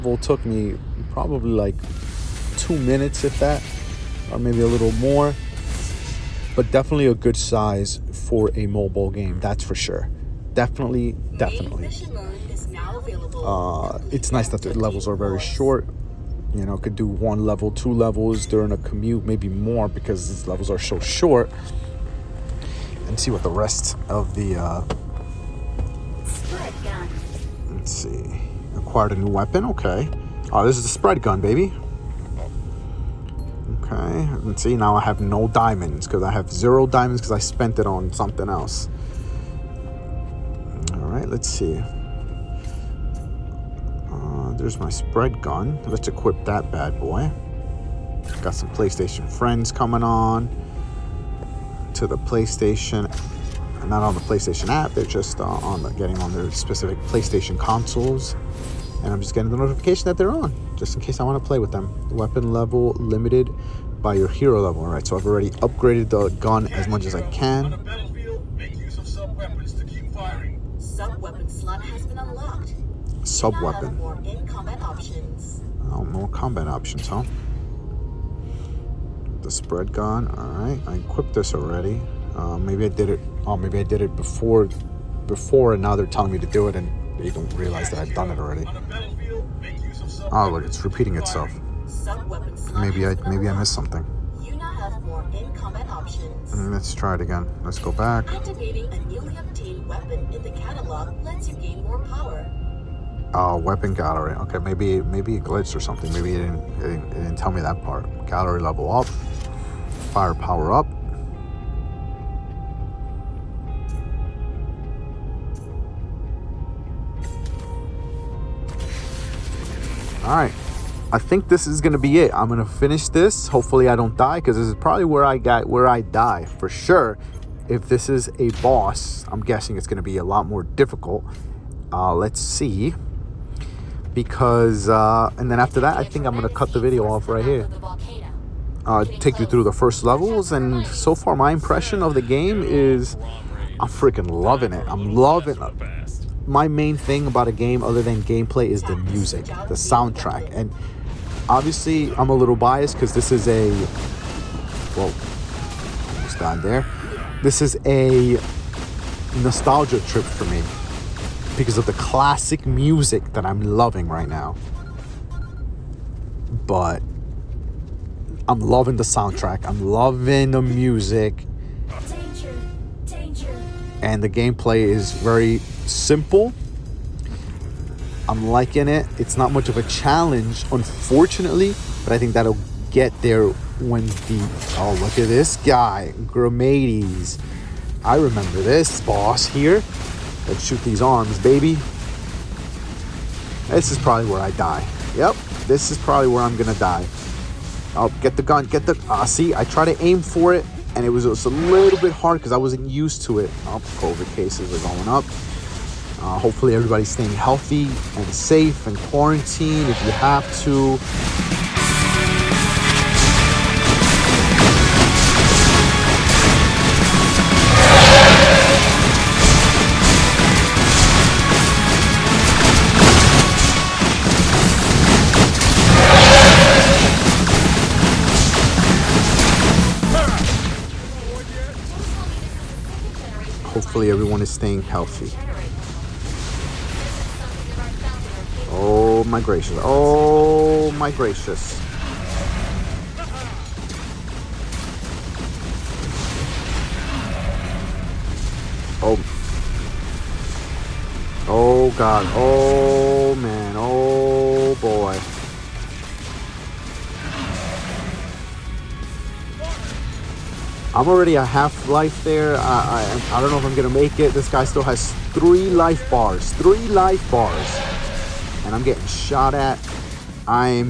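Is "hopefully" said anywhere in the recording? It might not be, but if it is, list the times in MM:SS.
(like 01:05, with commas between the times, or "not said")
02:03, 03:26, 03:53.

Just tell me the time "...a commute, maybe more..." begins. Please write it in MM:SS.
00:18.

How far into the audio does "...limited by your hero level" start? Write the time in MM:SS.
01:02.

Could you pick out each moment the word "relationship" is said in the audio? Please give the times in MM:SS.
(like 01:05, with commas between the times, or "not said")
not said.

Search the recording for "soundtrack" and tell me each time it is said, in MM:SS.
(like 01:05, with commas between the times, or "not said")
02:29, 02:49.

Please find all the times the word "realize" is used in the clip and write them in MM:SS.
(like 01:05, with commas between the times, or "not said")
01:27.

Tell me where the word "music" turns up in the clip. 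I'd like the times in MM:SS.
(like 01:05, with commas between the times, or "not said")
02:28, 02:42, 02:50.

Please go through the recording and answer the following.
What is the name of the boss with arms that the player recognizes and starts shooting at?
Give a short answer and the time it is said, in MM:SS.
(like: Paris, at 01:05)
Gromaides, at 03:06.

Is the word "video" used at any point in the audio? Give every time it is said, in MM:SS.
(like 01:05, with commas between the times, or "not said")
02:16.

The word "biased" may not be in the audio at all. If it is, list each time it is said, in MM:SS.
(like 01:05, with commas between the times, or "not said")
02:32.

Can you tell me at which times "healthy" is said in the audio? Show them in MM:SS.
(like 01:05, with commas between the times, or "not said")
03:27, 03:54.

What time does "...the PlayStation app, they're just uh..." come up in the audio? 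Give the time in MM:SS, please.
00:54.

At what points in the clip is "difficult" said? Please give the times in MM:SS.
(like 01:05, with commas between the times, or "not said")
02:10.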